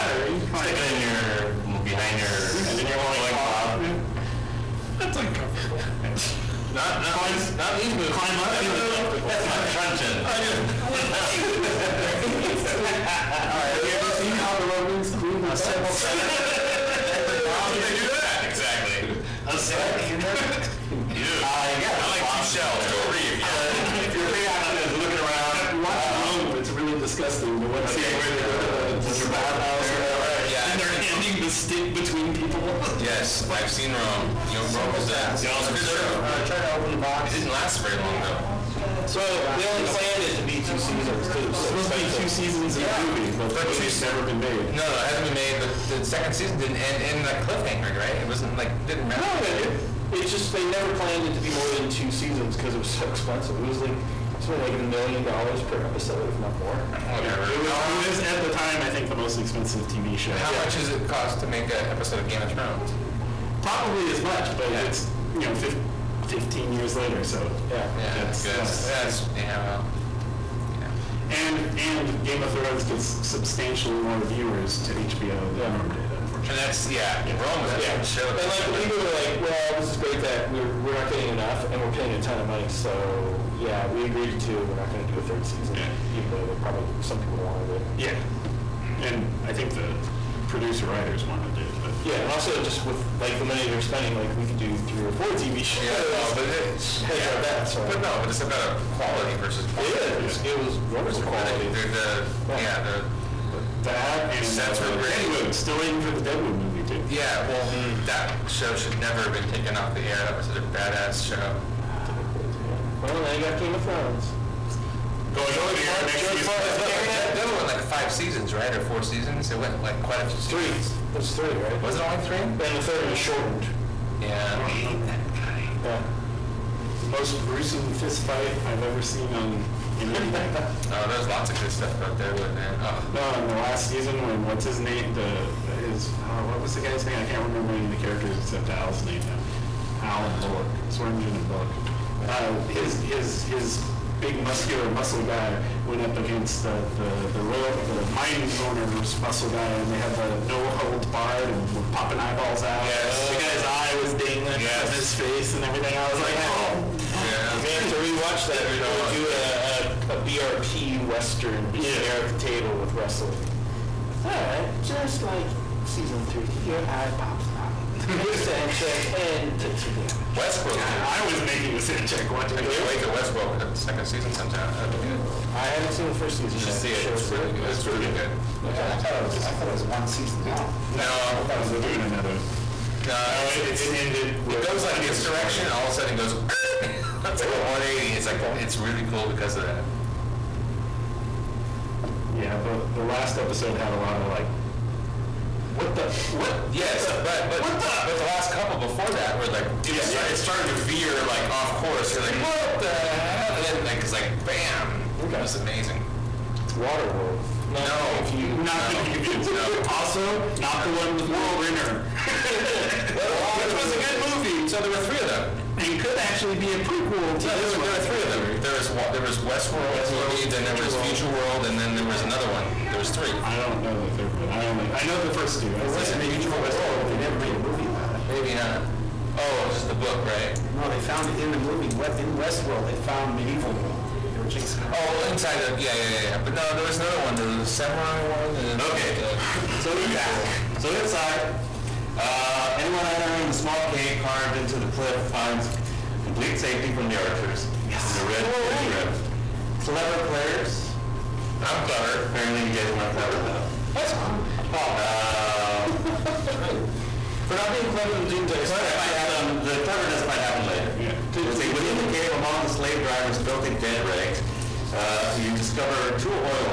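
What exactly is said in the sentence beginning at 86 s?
even though they probably some people wanted it.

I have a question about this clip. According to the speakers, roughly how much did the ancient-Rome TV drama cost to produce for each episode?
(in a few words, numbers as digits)
a million dollars.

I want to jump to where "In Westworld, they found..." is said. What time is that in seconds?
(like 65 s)
231 s.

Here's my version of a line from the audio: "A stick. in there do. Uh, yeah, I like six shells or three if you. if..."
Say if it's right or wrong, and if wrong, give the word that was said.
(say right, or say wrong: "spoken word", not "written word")
wrong: "two", not "six".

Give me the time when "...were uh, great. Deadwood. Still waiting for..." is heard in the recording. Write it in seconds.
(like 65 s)
104 s.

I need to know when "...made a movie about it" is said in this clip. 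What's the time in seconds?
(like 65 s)
227 s.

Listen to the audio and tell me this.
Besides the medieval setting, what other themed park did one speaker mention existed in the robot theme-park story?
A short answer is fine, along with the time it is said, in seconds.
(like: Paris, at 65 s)
a samurai one, at 237 s.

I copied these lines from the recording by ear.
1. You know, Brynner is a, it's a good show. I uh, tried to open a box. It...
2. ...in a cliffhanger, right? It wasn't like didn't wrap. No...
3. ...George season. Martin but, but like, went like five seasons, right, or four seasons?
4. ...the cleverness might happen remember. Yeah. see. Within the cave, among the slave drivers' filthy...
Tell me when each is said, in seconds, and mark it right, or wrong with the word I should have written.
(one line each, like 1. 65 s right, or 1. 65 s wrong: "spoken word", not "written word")
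1. 34 s wrong: "Rome", not "Brynner"
2. 47 s right
3. 116 s right
4. 259 s wrong: "later", not "remember".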